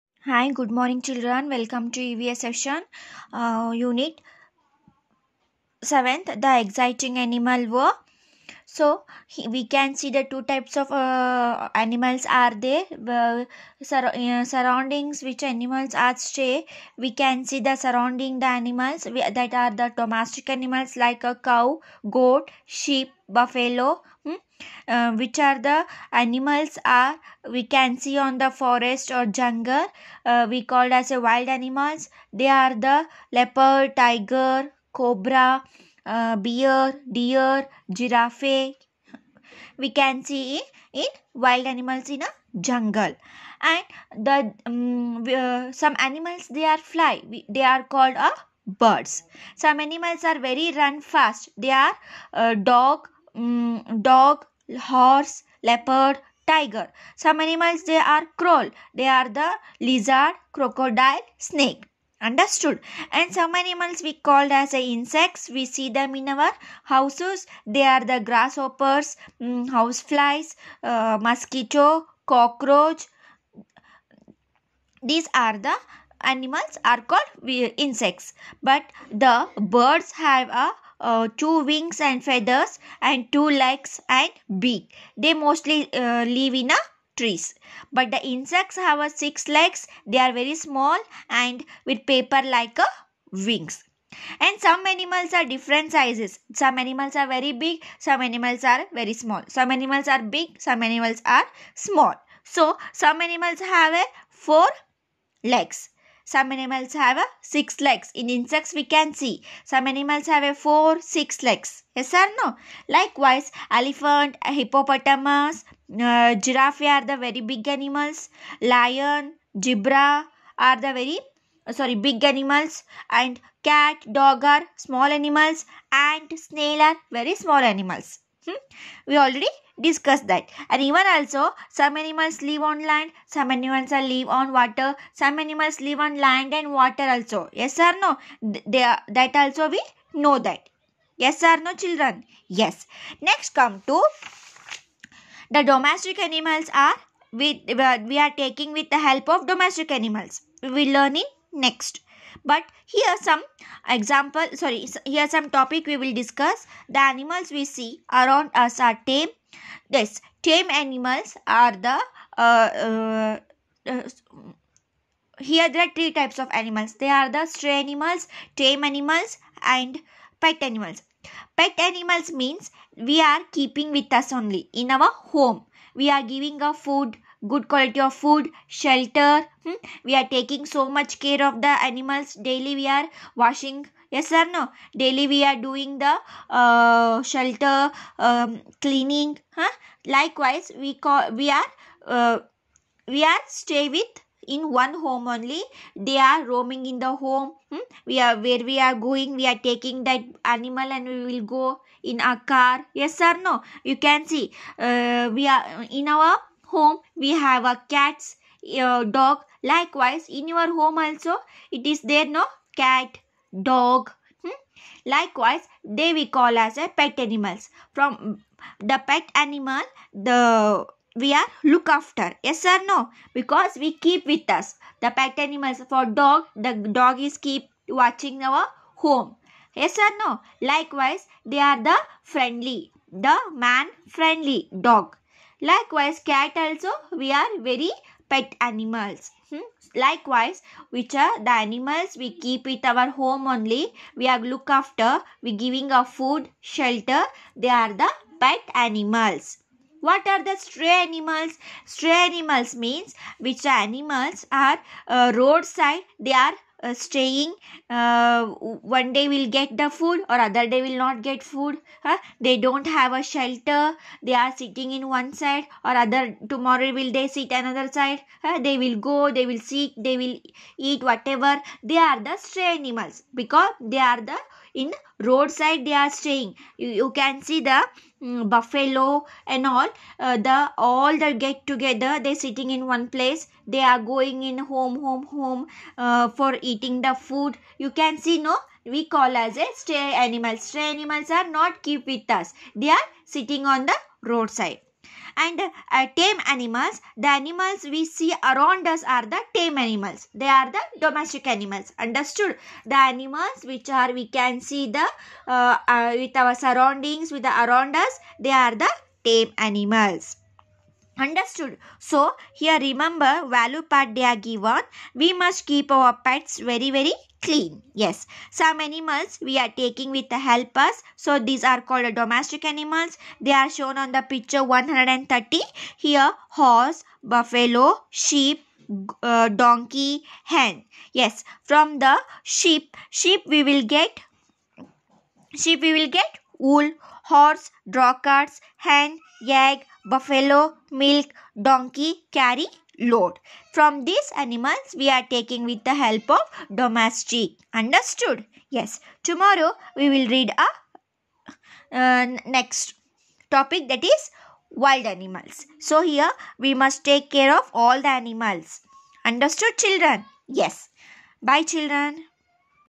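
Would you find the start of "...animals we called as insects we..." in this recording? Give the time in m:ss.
1:03.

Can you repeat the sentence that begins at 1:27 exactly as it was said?
But the insects have a six legs.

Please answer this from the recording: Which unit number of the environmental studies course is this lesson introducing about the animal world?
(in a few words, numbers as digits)
7.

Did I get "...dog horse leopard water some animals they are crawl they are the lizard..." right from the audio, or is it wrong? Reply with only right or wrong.
wrong.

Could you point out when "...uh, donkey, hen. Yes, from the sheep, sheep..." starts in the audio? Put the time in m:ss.
5:29.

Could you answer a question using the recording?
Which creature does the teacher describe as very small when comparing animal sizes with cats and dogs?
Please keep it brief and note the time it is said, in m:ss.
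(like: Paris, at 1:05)
snail, at 2:06.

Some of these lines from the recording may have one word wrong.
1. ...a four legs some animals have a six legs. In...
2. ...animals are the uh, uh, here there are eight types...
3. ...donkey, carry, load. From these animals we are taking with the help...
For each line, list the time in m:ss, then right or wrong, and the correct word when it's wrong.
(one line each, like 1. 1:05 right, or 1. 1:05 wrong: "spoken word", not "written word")
1. 1:43 right
2. 2:40 wrong: "three", not "eight"
3. 5:41 right.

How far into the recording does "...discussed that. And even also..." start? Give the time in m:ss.
2:09.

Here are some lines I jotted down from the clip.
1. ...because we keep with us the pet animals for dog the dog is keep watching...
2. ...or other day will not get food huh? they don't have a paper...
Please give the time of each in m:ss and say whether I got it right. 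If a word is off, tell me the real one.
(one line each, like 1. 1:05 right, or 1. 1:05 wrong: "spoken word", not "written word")
1. 3:43 right
2. 4:20 wrong: "shelter", not "paper".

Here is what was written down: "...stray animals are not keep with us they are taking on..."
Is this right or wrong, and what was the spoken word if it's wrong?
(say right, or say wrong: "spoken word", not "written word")
wrong: "sitting", not "taking".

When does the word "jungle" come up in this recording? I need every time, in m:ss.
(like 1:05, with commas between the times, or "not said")
0:29, 0:42.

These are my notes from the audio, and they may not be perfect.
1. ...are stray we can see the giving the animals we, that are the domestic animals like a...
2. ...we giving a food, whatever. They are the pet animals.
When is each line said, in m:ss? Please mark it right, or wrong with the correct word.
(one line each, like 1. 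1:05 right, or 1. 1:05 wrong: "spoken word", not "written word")
1. 0:15 wrong: "surrounding", not "giving"
2. 4:05 wrong: "shelter", not "whatever".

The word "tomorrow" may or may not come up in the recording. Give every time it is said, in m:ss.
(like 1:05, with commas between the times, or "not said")
4:26, 5:49.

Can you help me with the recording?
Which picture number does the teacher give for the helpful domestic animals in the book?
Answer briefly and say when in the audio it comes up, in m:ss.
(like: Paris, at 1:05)
130, at 5:24.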